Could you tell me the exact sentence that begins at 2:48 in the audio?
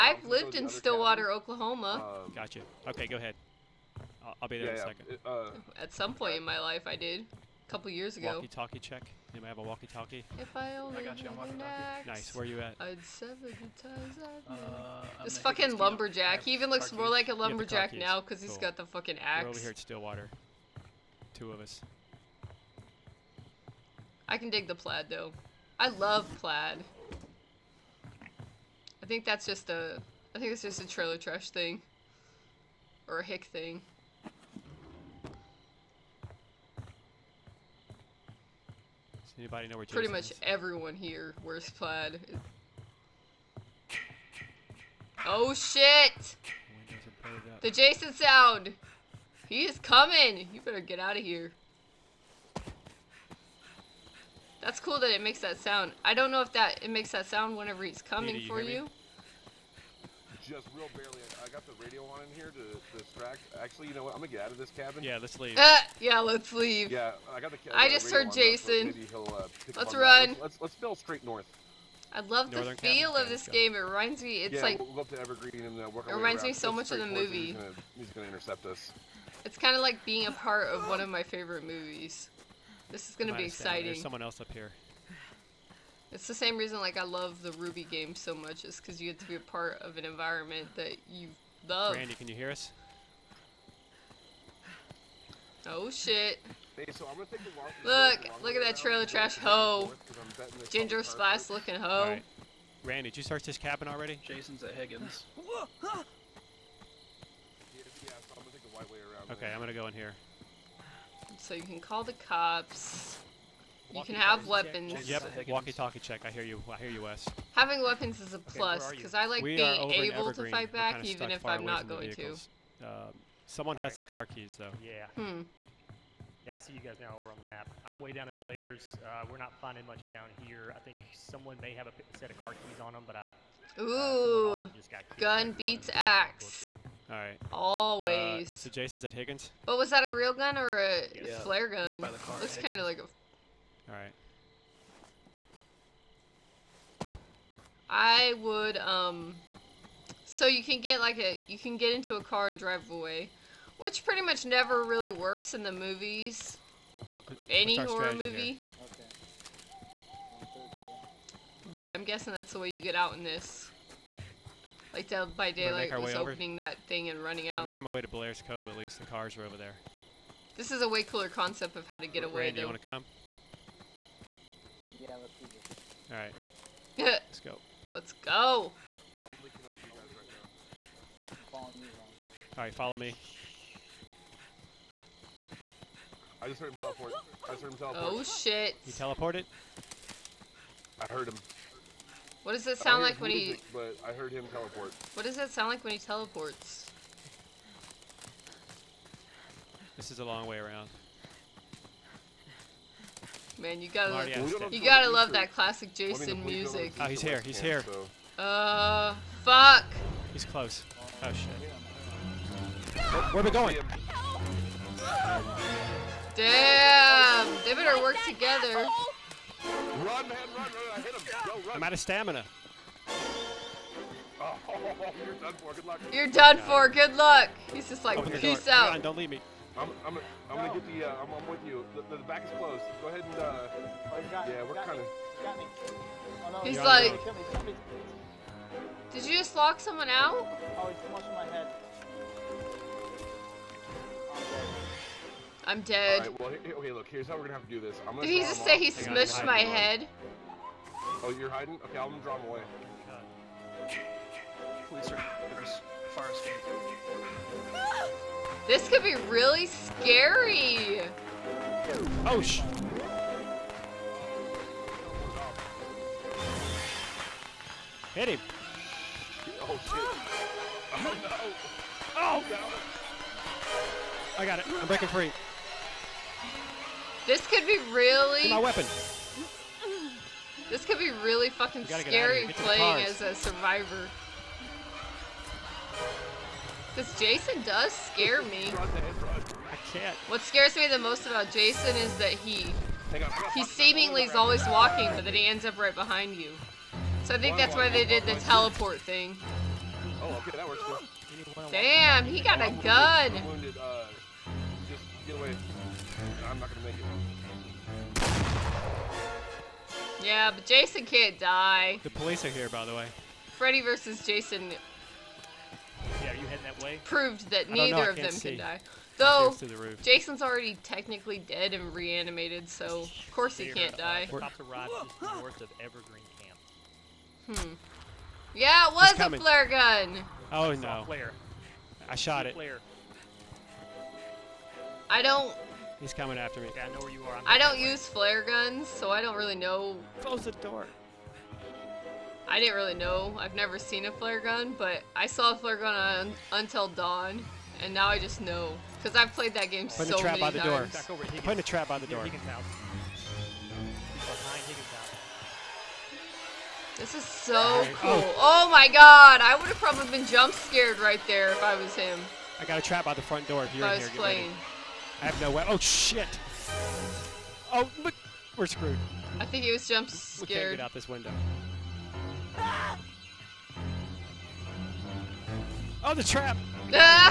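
At least the cars were over there.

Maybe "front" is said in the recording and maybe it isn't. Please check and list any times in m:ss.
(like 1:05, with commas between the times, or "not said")
6:03.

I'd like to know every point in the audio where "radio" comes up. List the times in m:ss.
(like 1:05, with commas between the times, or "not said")
1:01.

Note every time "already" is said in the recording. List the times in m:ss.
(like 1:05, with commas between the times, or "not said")
1:43, 5:20.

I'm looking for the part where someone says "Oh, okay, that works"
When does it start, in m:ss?
5:00.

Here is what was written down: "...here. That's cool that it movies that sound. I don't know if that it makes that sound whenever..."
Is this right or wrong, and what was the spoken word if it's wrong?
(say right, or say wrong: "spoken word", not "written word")
wrong: "makes", not "movies".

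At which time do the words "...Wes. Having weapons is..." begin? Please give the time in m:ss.
1:57.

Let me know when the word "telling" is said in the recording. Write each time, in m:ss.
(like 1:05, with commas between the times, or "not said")
not said.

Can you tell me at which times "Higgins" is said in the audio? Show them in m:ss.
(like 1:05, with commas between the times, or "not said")
1:44, 2:19.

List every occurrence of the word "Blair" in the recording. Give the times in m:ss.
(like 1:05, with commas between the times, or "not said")
2:08, 2:48.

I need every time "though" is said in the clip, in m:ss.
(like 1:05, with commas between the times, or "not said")
0:25, 2:04, 5:19.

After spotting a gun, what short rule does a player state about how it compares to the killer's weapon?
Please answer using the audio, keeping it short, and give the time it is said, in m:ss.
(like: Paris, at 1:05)
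Gun beats axe, at 2:15.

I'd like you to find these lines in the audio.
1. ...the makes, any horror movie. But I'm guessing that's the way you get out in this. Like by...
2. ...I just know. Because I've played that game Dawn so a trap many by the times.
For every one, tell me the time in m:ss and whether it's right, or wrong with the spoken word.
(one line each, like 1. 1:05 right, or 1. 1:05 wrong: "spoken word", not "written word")
1. 2:35 wrong: "movies", not "makes"
2. 5:48 wrong: "Putting", not "Dawn".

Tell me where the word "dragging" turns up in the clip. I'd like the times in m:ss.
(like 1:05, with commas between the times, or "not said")
not said.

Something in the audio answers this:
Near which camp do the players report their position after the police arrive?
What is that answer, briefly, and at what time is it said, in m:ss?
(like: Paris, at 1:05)
Evergreen Camp, at 5:24.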